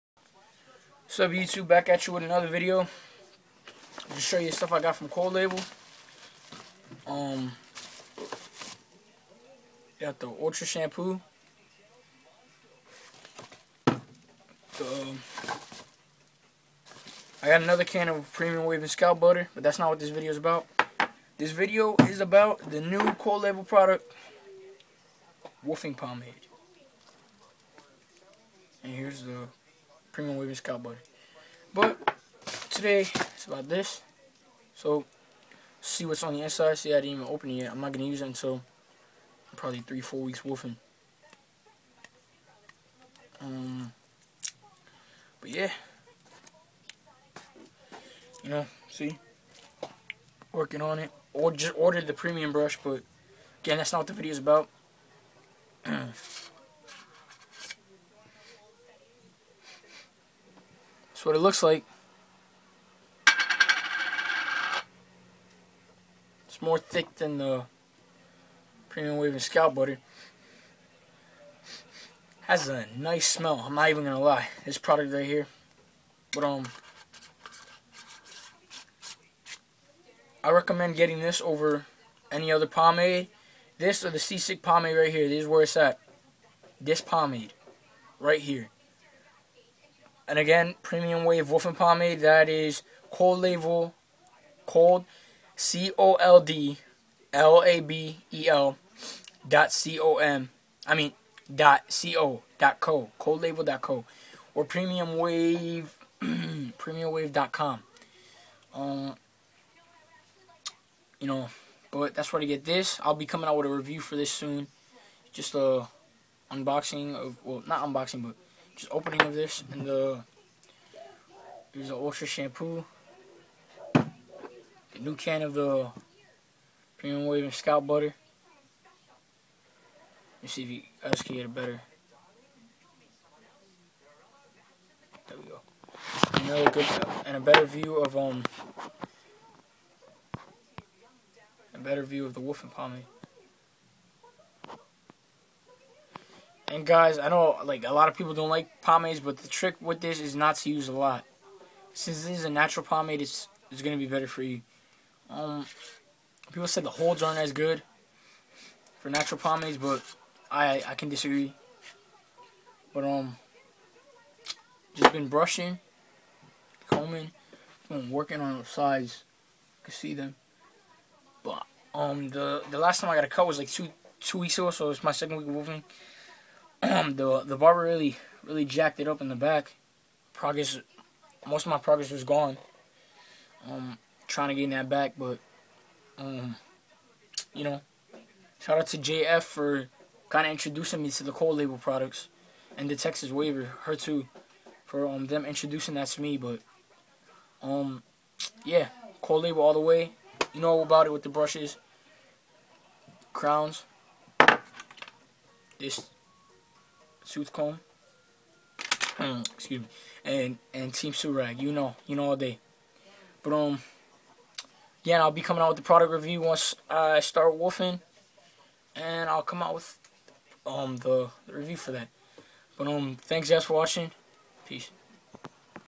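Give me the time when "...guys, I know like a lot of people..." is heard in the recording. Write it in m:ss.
2:26.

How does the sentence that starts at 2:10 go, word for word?
Let's see if you guys can get it better.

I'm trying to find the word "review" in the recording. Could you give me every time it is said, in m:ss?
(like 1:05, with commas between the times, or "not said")
1:53, 3:36, 3:41.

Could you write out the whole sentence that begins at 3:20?
You know about it with the brushes, crowns.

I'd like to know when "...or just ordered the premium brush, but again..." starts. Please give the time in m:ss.
0:51.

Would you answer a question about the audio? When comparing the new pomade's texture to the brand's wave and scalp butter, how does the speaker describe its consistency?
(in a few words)
more thick.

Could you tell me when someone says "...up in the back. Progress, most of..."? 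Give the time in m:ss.
2:59.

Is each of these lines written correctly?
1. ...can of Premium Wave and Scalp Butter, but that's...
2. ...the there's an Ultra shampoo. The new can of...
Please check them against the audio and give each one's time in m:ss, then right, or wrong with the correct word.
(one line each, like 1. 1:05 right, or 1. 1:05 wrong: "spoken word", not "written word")
1. 0:17 right
2. 1:59 right.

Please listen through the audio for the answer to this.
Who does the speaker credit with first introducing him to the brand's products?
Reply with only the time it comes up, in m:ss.
3:08.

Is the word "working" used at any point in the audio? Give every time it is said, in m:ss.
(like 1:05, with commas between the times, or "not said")
0:50, 2:48.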